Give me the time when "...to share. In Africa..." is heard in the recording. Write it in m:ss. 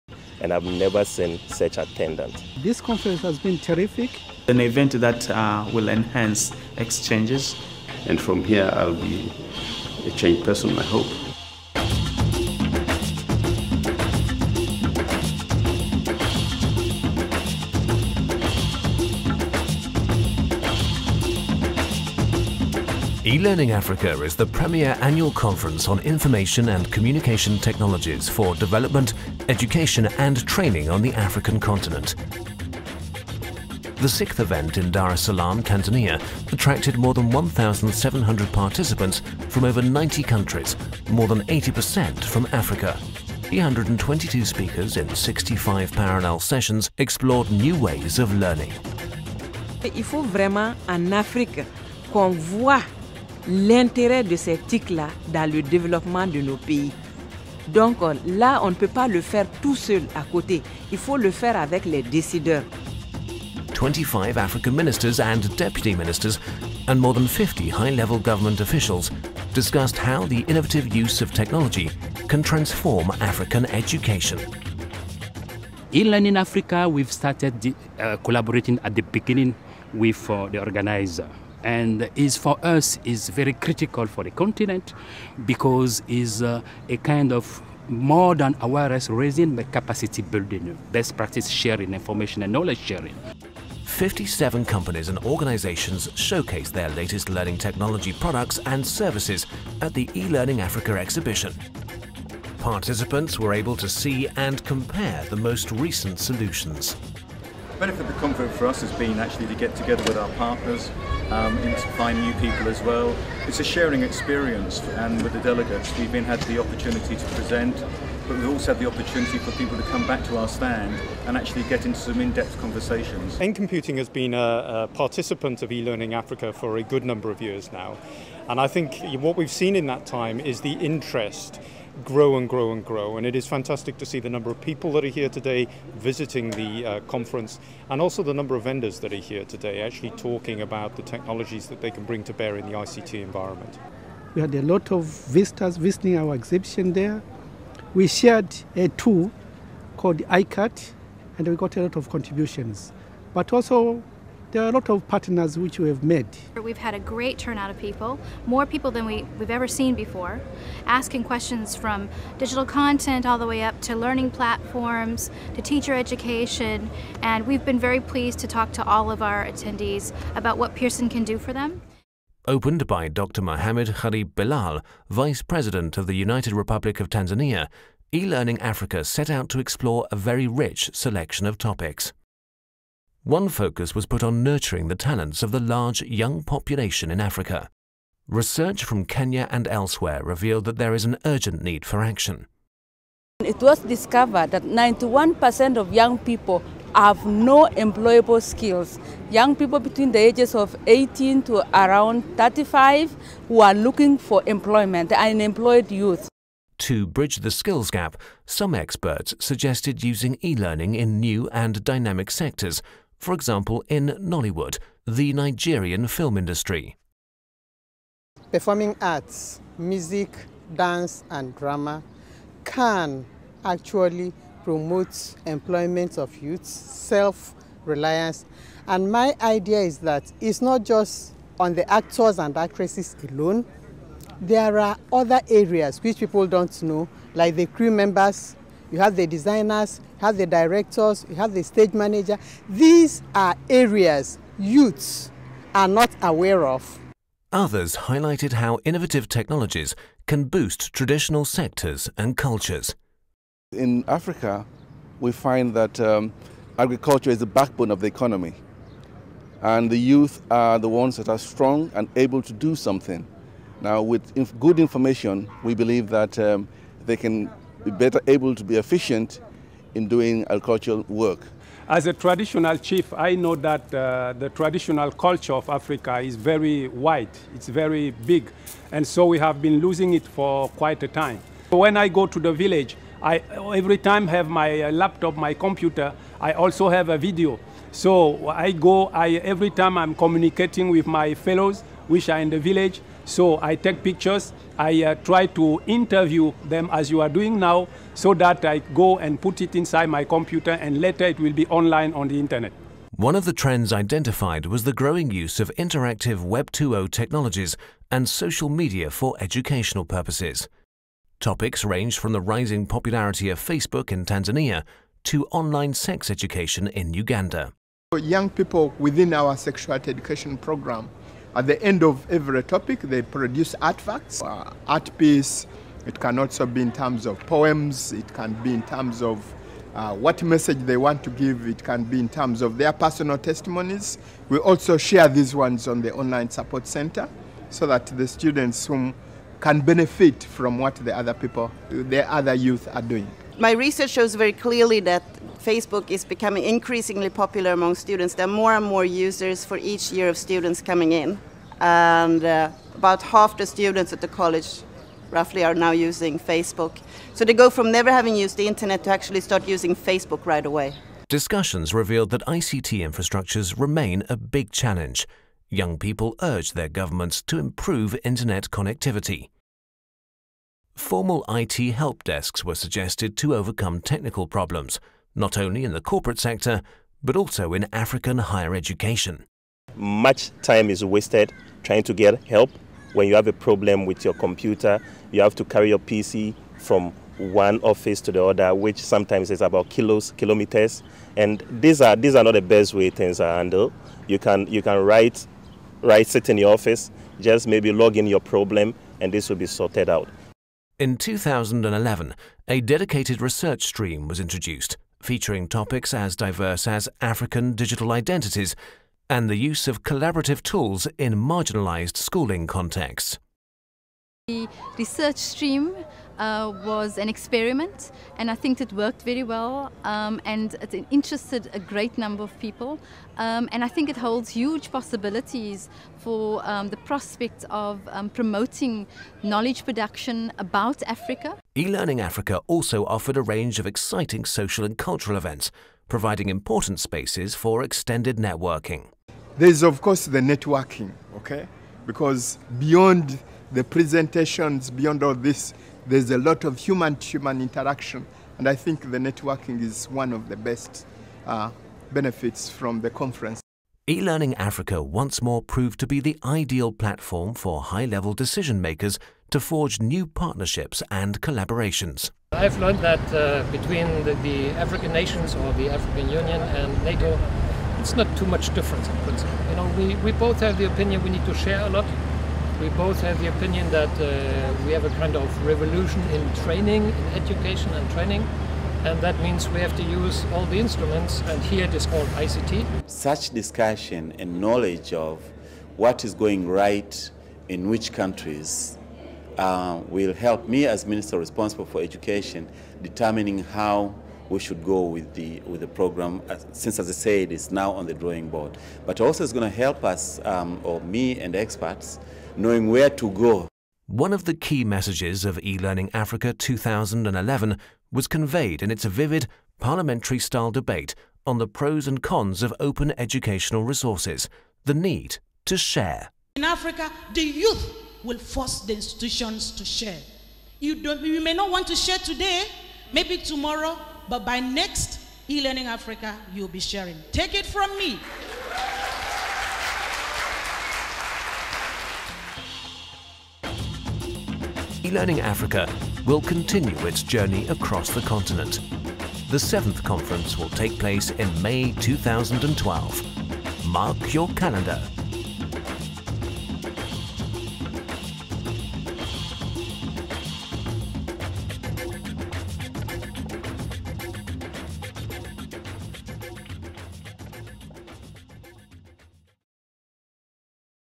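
8:35.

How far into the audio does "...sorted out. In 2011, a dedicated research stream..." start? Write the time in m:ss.
6:39.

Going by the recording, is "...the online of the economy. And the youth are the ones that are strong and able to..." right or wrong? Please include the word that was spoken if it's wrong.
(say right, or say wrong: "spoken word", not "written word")
wrong: "backbone", not "online".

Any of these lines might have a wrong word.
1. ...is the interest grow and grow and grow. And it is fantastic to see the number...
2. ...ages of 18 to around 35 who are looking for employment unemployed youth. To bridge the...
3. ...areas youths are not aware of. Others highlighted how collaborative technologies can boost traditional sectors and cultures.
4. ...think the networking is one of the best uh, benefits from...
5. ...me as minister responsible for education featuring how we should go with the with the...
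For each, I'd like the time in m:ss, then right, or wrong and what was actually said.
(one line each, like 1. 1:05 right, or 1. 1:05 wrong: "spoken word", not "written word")
1. 2:10 right
2. 3:20 right
3. 4:03 wrong: "innovative", not "collaborative"
4. 7:28 right
5. 8:10 wrong: "determining", not "featuring".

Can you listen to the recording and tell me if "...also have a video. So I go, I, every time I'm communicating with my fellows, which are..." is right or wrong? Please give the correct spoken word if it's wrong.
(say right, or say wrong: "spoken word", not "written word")
right.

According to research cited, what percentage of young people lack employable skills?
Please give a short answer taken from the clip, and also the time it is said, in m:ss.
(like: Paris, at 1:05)
91%, at 3:14.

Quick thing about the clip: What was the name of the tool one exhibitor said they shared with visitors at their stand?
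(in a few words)
iCut.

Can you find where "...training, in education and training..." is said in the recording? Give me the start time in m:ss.
7:56.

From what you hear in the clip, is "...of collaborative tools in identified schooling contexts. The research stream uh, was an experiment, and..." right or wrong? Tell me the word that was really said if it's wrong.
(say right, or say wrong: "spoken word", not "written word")
wrong: "marginalized", not "identified".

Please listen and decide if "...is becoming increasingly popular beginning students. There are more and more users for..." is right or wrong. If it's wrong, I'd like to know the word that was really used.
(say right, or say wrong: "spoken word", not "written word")
wrong: "among", not "beginning".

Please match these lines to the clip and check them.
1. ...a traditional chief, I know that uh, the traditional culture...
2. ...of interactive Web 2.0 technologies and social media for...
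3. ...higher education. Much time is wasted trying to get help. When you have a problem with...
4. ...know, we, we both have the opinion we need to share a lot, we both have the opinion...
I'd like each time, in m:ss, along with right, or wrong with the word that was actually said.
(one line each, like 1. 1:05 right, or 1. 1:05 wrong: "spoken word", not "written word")
1. 4:32 right
2. 5:05 right
3. 6:18 right
4. 7:49 right.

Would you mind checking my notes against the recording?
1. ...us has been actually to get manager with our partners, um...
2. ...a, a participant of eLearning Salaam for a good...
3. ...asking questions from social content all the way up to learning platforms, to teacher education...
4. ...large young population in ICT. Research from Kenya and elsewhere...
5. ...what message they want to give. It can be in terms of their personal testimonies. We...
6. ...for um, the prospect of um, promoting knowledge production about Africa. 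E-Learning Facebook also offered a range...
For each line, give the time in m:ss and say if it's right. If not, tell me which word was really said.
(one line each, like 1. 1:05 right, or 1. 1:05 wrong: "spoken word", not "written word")
1. 1:48 wrong: "together", not "manager"
2. 2:04 wrong: "Africa", not "Salaam"
3. 2:40 wrong: "digital", not "social"
4. 3:05 wrong: "Africa", not "ICT"
5. 5:30 right
6. 7:06 wrong: "Africa", not "Facebook".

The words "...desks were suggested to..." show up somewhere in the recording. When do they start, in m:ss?
6:12.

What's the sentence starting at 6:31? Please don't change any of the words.
And these are, these are not the best way things are handled.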